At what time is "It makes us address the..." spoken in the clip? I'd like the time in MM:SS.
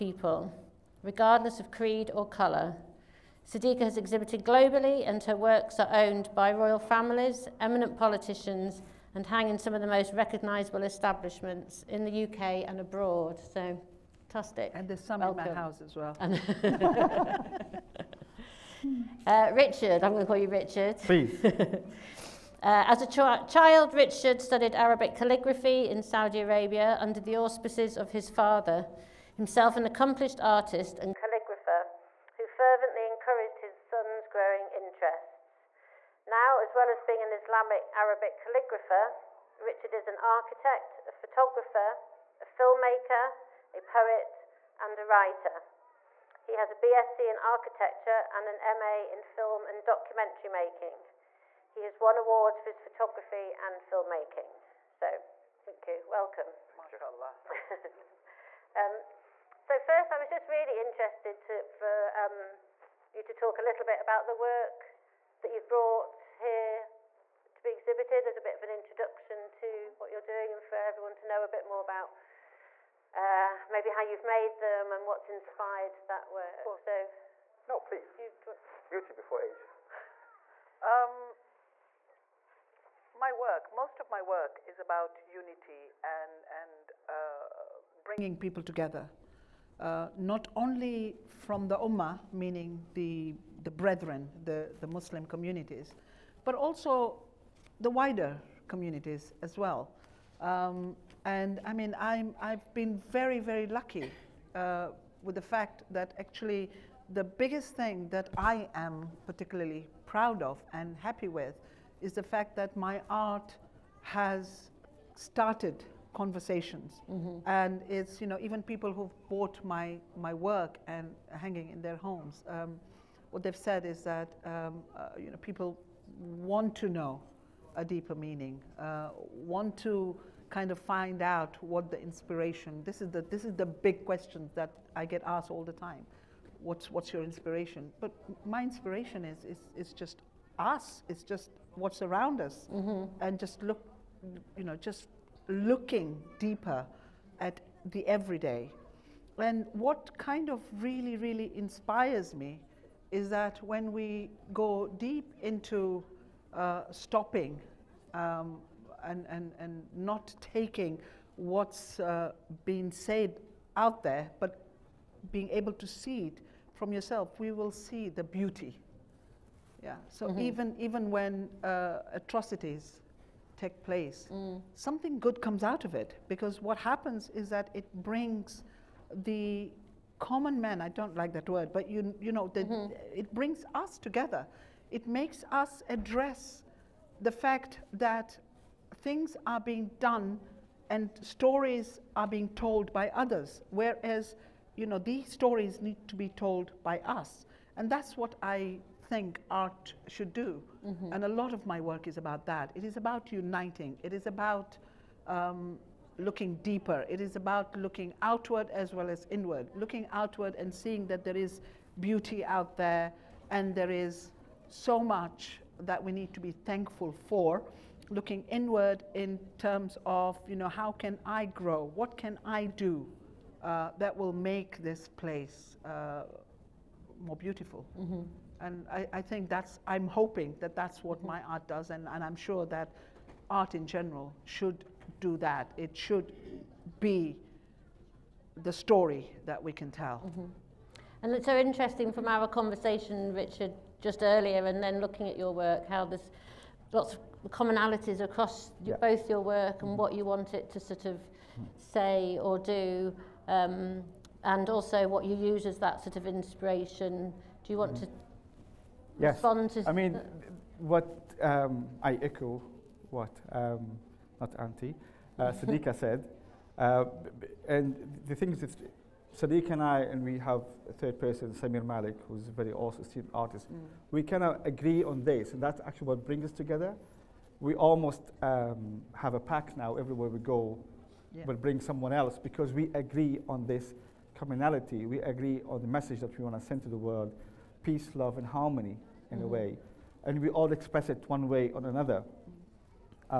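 03:04.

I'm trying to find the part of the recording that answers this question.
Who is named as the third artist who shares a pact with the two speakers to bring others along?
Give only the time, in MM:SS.
04:31.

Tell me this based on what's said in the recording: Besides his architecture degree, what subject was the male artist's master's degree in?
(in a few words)
Film and documentary making.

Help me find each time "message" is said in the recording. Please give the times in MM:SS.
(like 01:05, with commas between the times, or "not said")
04:45.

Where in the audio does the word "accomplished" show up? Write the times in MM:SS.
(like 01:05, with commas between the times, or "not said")
00:29.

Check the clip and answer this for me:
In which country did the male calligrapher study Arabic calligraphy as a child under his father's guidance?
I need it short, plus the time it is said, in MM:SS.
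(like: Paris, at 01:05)
Saudi Arabia, at 00:26.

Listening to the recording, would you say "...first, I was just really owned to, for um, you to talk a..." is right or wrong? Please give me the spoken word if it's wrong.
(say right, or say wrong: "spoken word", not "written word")
wrong: "interested", not "owned".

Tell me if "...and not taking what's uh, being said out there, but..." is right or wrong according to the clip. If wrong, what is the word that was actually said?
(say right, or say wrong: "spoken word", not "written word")
right.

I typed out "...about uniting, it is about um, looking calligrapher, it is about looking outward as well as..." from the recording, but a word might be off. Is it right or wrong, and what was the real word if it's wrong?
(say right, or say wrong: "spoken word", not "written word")
wrong: "deeper", not "calligrapher".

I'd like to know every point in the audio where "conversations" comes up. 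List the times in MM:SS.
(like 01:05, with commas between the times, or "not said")
01:56, 04:02.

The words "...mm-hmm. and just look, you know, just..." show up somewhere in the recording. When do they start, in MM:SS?
02:22.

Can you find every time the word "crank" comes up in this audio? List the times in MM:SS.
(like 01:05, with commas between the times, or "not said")
not said.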